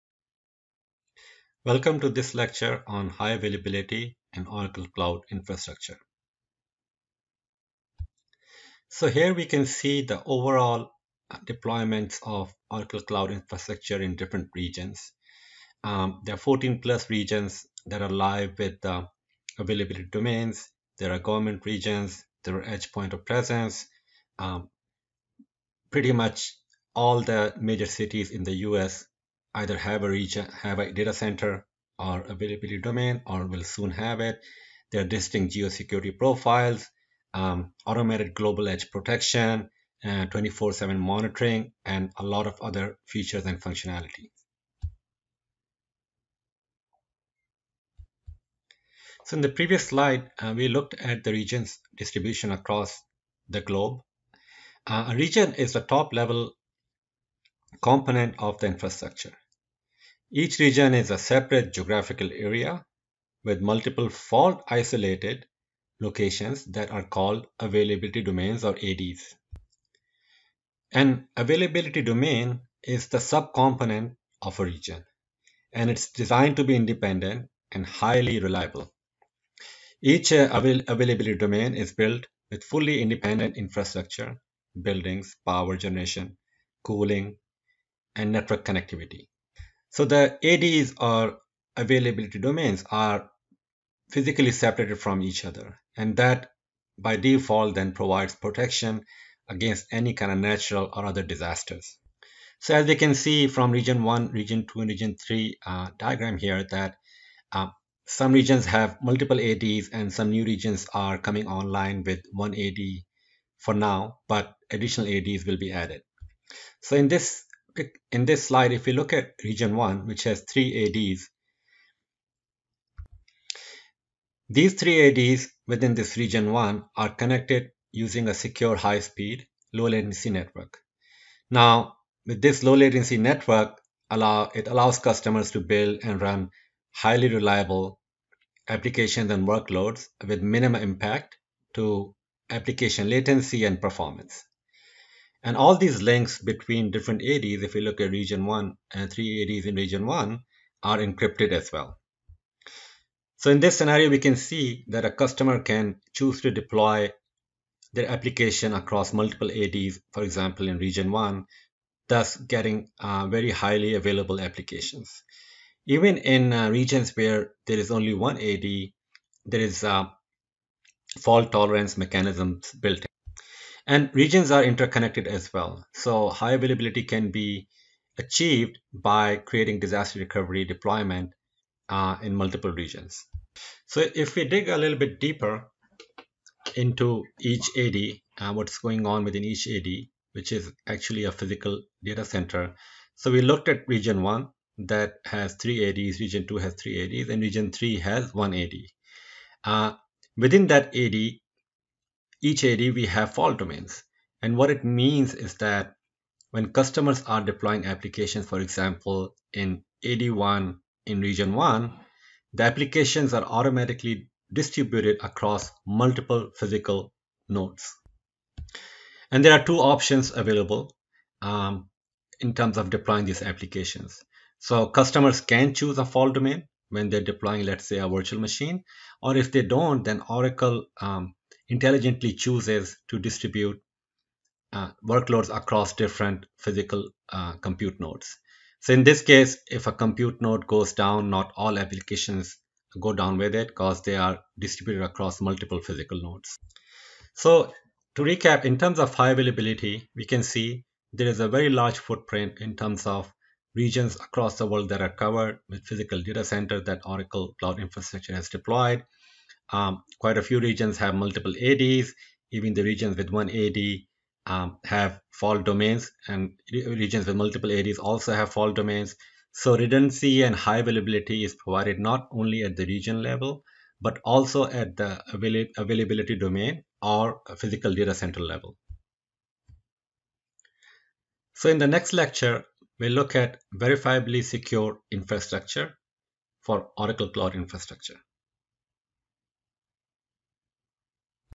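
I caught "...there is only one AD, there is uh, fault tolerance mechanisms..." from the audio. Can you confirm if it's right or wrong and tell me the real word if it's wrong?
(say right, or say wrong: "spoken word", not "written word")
right.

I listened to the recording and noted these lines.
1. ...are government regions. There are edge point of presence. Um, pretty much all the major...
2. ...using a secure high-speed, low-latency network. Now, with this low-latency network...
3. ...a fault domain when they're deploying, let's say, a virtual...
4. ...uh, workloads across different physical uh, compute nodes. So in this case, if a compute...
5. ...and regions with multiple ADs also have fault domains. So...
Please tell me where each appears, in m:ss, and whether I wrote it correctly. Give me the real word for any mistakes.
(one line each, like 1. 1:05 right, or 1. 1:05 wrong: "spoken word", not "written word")
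1. 0:21 right
2. 2:07 right
3. 3:45 right
4. 3:54 right
5. 4:26 right.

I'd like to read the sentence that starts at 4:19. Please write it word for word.
Um, quite a few regions have multiple ADs.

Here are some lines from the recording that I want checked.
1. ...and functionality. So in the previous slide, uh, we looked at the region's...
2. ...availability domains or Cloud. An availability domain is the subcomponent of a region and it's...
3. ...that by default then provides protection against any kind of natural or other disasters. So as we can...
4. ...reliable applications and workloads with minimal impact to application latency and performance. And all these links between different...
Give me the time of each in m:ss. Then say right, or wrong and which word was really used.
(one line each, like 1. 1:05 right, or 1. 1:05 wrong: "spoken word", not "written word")
1. 0:43 right
2. 1:07 wrong: "ADs", not "Cloud"
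3. 1:36 right
4. 2:17 right.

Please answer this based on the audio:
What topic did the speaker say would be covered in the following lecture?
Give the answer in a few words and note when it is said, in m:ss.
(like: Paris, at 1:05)
verifiably secure infrastructure, at 4:43.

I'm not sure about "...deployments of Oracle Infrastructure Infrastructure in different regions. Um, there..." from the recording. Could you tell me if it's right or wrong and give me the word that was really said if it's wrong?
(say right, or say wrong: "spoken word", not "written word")
wrong: "Cloud", not "Infrastructure".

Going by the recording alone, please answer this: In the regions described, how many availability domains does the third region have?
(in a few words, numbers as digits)
1.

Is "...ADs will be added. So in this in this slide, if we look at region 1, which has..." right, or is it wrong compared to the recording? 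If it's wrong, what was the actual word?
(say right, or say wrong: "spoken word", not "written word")
right.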